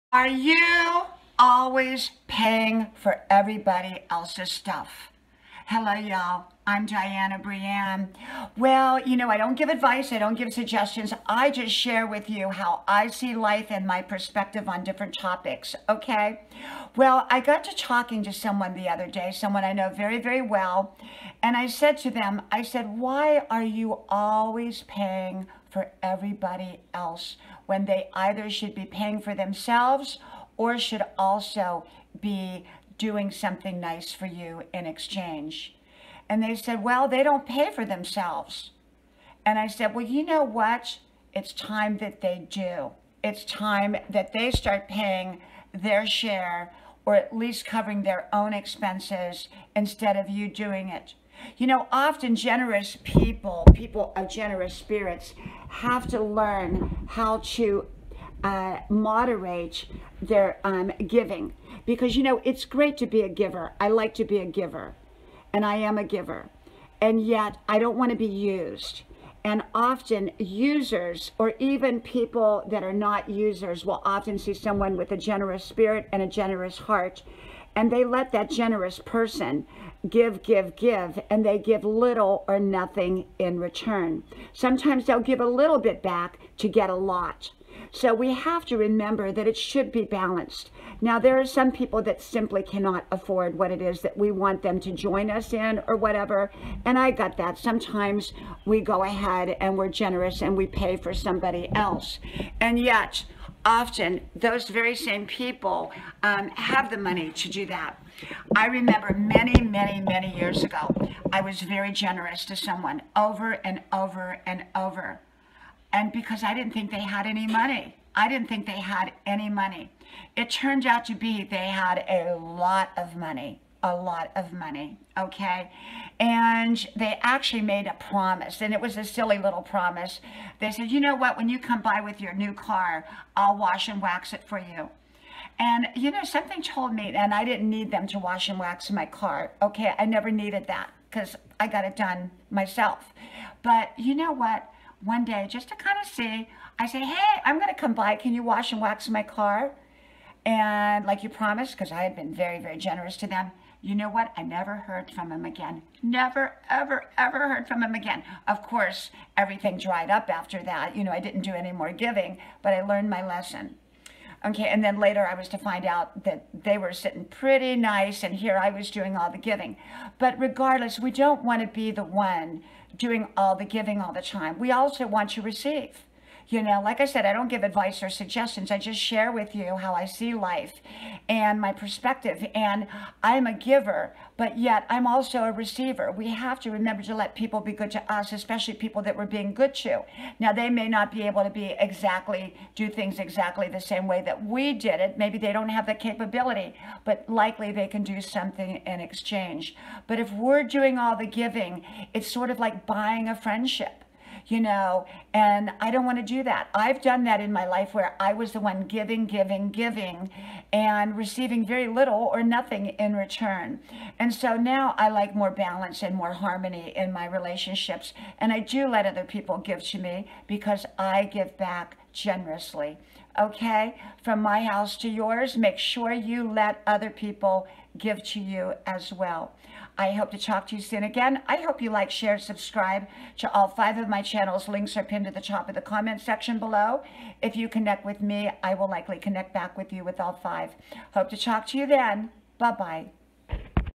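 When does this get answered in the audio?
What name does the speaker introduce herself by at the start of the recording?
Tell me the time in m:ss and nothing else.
0:06.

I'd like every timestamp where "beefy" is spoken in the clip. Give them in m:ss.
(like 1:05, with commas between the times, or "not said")
not said.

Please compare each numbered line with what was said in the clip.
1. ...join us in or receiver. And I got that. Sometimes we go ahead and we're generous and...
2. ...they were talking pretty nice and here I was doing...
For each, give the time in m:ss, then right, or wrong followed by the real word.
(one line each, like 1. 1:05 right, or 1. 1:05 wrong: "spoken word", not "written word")
1. 1:34 wrong: "whatever", not "receiver"
2. 2:46 wrong: "sitting", not "talking".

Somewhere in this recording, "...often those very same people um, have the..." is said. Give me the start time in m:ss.
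1:43.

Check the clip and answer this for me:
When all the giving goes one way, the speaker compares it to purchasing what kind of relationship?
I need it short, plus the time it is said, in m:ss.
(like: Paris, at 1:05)
A friendship, at 3:23.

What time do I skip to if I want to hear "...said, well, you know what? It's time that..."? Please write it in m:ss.
0:39.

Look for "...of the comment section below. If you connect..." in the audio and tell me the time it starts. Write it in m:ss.
3:55.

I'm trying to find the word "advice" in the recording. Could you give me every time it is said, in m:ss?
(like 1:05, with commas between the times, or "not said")
0:09, 2:57.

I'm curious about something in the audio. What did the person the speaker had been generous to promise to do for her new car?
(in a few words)
Wash and wax it.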